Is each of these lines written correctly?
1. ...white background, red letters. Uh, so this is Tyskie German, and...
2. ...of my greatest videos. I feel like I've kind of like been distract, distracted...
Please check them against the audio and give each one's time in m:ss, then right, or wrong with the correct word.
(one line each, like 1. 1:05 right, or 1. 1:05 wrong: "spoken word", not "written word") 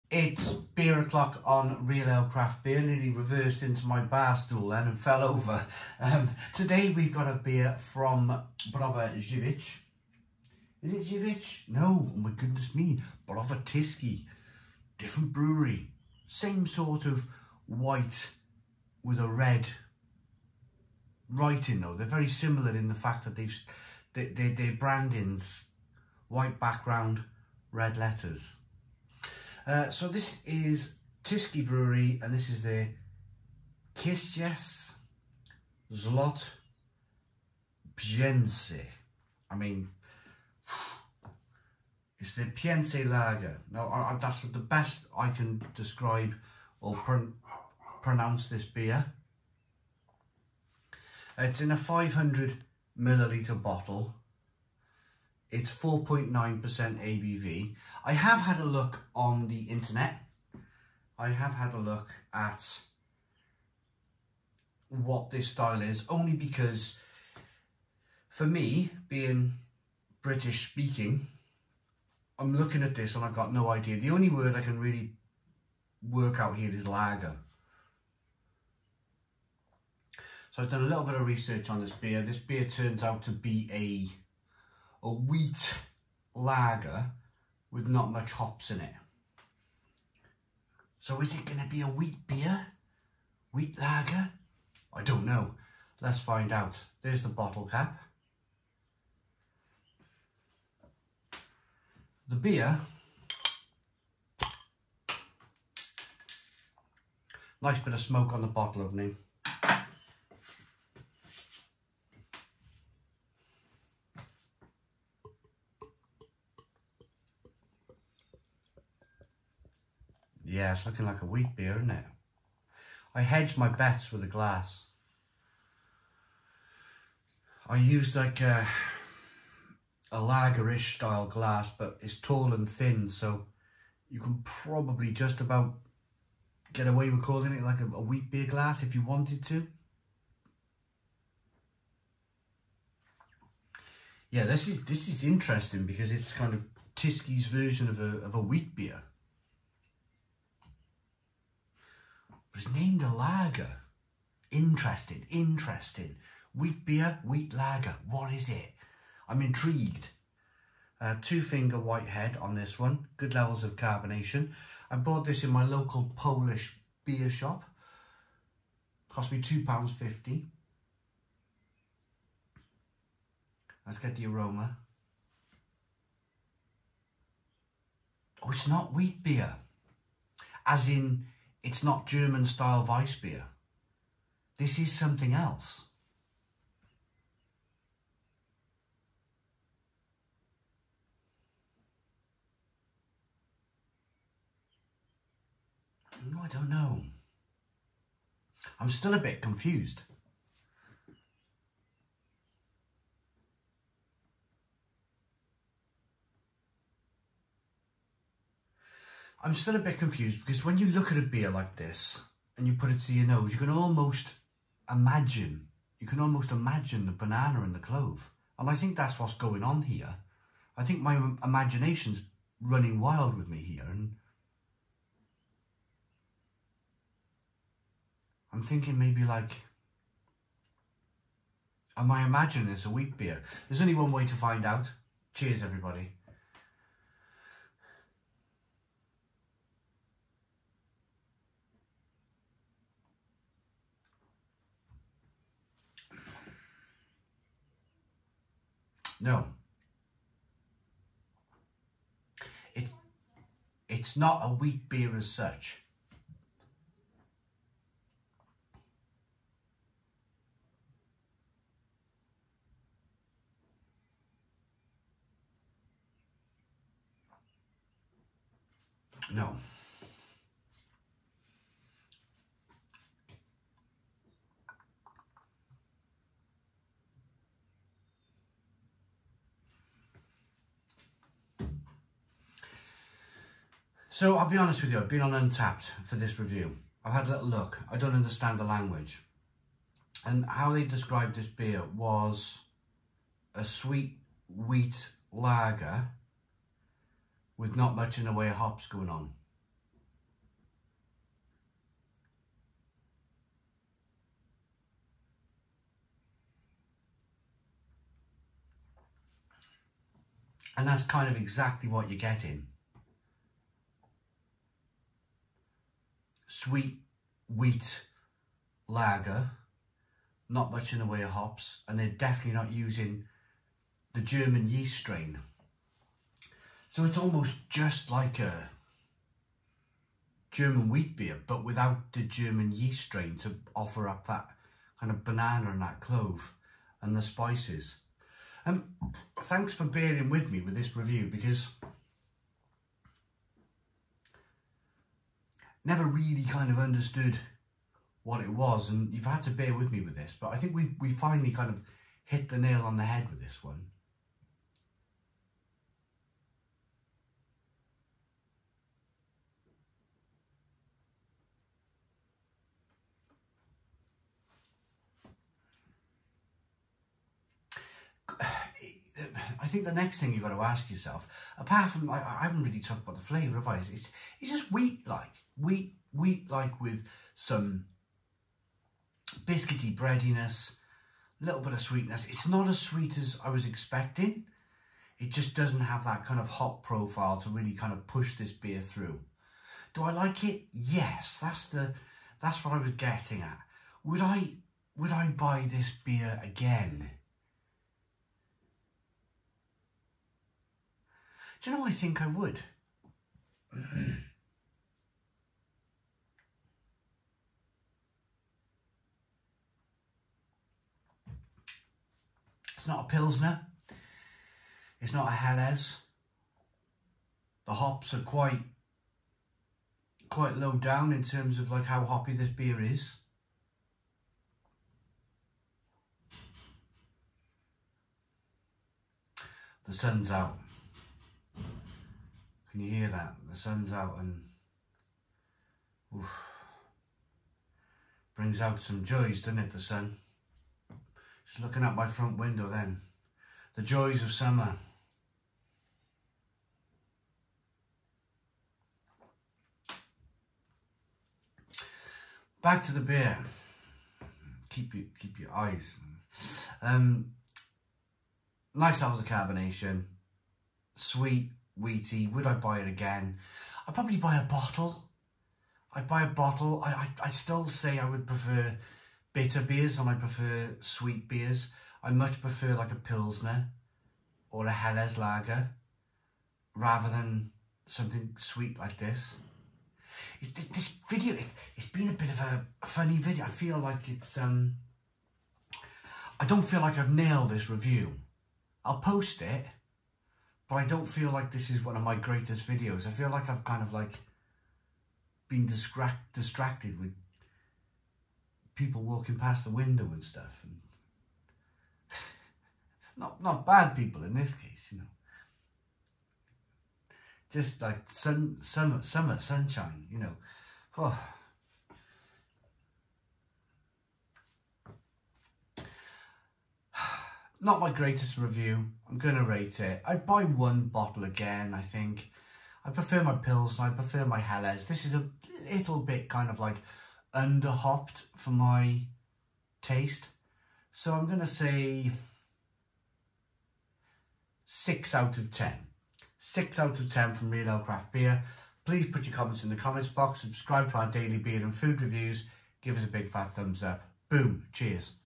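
1. 0:26 wrong: "Brewery", not "German"
2. 8:11 right.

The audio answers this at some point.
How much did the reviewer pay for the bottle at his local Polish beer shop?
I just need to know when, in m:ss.
2:49.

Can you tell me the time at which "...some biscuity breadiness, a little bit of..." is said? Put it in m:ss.
6:17.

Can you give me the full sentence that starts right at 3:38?
And I think that's what's going on here.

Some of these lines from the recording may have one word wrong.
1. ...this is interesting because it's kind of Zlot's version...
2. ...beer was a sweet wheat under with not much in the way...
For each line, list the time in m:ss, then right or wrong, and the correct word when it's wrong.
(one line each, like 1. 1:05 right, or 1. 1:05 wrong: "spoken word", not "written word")
1. 2:24 wrong: "Tyskie", not "Zlot"
2. 4:51 wrong: "lager", not "under".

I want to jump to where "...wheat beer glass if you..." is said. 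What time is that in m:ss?
2:18.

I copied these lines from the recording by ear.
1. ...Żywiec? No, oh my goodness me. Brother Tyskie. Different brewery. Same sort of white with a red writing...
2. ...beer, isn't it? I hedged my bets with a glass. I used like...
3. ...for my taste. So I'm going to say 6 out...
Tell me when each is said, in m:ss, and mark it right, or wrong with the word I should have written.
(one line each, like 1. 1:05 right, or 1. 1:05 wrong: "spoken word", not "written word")
1. 0:11 right
2. 2:01 right
3. 8:48 right.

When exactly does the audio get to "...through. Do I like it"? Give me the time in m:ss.
6:28.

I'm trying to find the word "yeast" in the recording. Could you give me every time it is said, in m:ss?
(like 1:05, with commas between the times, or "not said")
5:24, 5:32.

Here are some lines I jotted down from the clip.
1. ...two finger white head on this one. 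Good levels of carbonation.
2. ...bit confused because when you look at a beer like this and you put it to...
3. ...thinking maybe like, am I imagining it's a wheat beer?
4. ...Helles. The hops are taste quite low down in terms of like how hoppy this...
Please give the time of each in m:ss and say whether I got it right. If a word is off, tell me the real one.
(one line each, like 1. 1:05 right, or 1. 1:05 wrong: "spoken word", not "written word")
1. 2:41 right
2. 3:29 right
3. 3:48 right
4. 6:55 wrong: "quite", not "taste".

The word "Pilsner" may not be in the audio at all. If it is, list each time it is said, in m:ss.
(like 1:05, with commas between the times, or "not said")
6:53, 7:52.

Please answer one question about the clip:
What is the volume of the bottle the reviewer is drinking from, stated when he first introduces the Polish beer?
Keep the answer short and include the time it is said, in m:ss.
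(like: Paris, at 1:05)
500 milliliters, at 0:51.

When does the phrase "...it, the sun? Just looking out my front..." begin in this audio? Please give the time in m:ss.
7:19.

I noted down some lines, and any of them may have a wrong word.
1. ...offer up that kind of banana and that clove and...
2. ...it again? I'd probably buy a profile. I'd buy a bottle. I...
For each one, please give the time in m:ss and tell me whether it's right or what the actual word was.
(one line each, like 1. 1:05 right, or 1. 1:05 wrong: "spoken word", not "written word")
1. 5:33 right
2. 7:42 wrong: "bottle", not "profile".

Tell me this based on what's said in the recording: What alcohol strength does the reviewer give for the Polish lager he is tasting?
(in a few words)
4.9%.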